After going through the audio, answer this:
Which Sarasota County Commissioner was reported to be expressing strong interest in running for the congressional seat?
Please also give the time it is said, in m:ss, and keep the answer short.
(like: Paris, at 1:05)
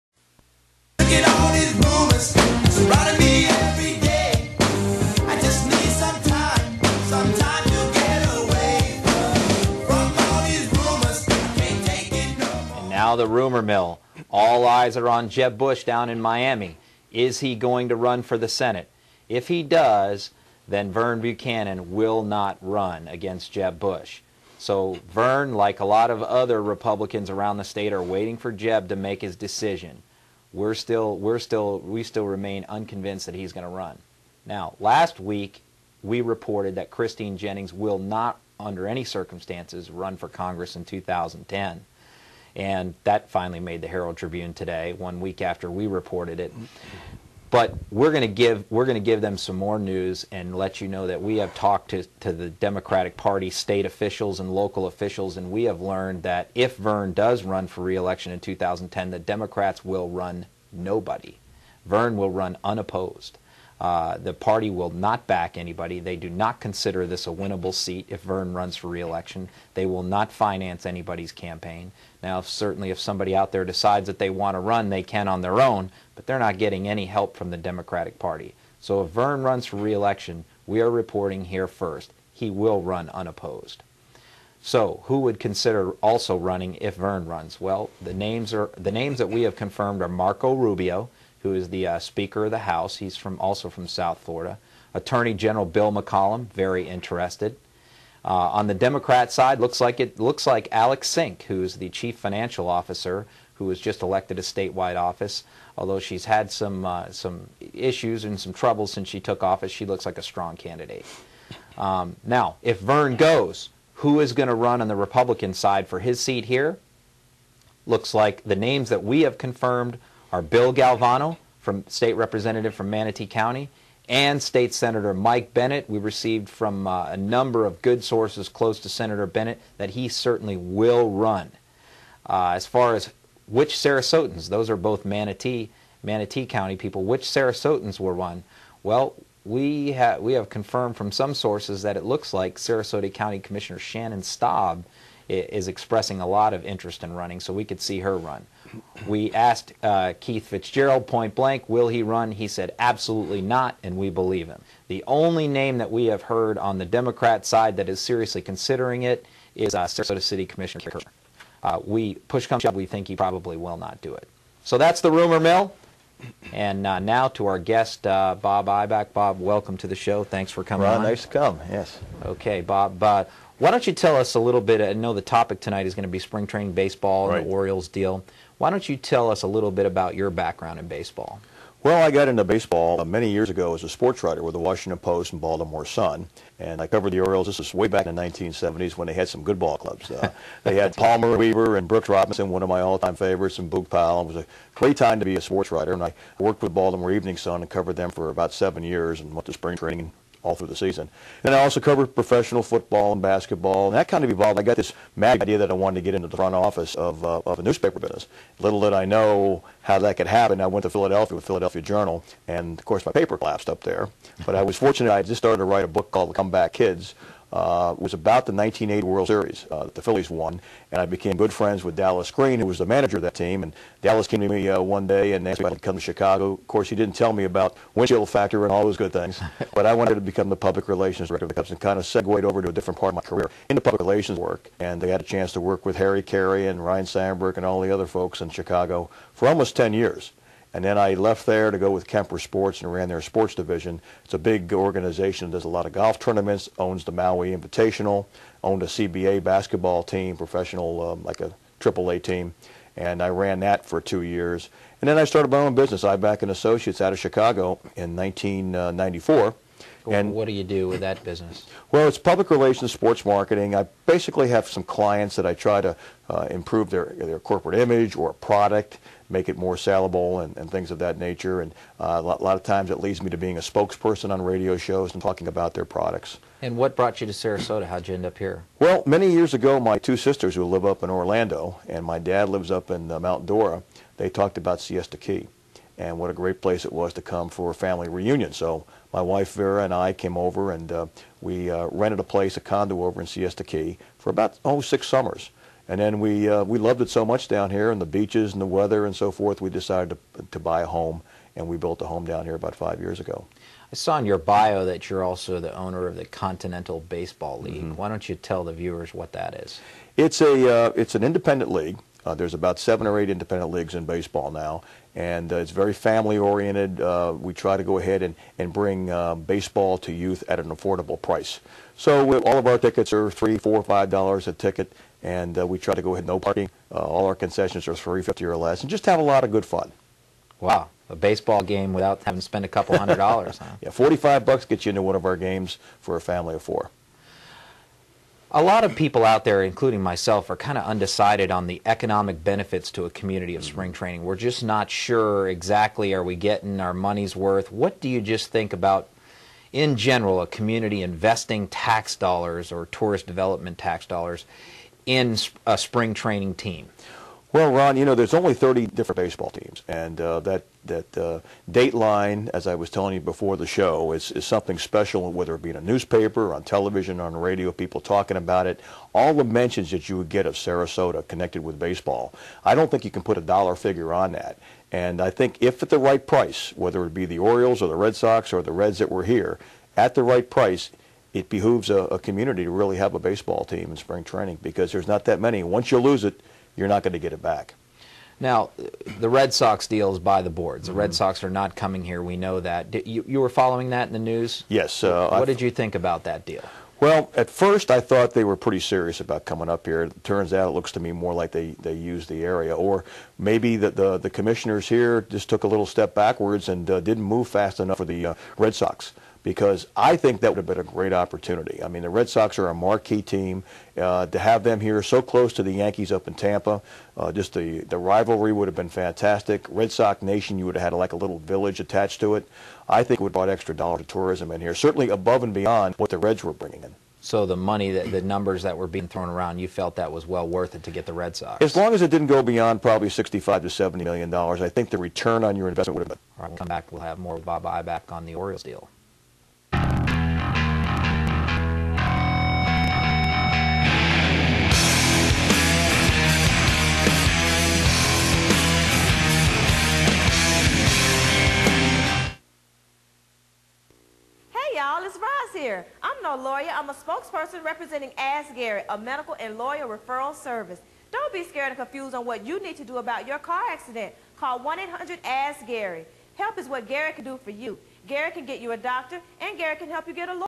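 Shannon Staub, at 2:23.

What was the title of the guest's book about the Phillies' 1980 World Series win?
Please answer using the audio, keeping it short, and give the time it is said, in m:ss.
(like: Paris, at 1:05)
The Comeback Kids, at 3:36.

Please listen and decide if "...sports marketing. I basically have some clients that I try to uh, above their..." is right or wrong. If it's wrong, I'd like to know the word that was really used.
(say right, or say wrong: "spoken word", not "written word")
wrong: "improve", not "above".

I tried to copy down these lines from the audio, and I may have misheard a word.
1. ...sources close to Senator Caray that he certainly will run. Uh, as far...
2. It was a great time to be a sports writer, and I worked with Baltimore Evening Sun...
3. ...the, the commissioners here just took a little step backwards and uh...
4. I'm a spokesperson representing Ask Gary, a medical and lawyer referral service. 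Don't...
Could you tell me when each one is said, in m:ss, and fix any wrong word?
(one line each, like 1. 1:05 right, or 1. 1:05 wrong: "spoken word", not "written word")
1. 2:08 wrong: "Bennett", not "Caray"
2. 3:14 right
3. 6:43 right
4. 7:36 right.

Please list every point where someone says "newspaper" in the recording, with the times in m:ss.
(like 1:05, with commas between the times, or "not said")
3:27, 6:05.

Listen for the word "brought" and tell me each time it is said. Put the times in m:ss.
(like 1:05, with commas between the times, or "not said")
4:36, 7:03.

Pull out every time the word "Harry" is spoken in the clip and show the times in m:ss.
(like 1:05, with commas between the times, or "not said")
3:55.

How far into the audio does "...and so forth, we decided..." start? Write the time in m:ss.
4:59.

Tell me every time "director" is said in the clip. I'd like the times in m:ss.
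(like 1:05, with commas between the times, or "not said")
3:51.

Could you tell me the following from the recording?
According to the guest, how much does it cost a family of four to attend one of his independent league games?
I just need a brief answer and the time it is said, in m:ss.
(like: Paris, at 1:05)
$45, at 5:33.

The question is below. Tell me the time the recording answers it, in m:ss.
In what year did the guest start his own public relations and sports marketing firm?
4:18.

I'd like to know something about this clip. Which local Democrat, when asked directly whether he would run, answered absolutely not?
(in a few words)
Keith Fitzgerald.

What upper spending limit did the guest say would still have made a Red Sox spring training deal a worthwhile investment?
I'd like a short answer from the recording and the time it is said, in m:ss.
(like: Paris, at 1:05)
$70 million, at 7:13.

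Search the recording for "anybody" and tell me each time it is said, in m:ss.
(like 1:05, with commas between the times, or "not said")
1:05, 1:10.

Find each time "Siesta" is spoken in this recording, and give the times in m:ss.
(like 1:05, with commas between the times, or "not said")
4:44, 4:53.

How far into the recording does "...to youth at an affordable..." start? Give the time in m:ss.
5:19.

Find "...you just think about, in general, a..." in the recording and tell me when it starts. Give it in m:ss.
5:48.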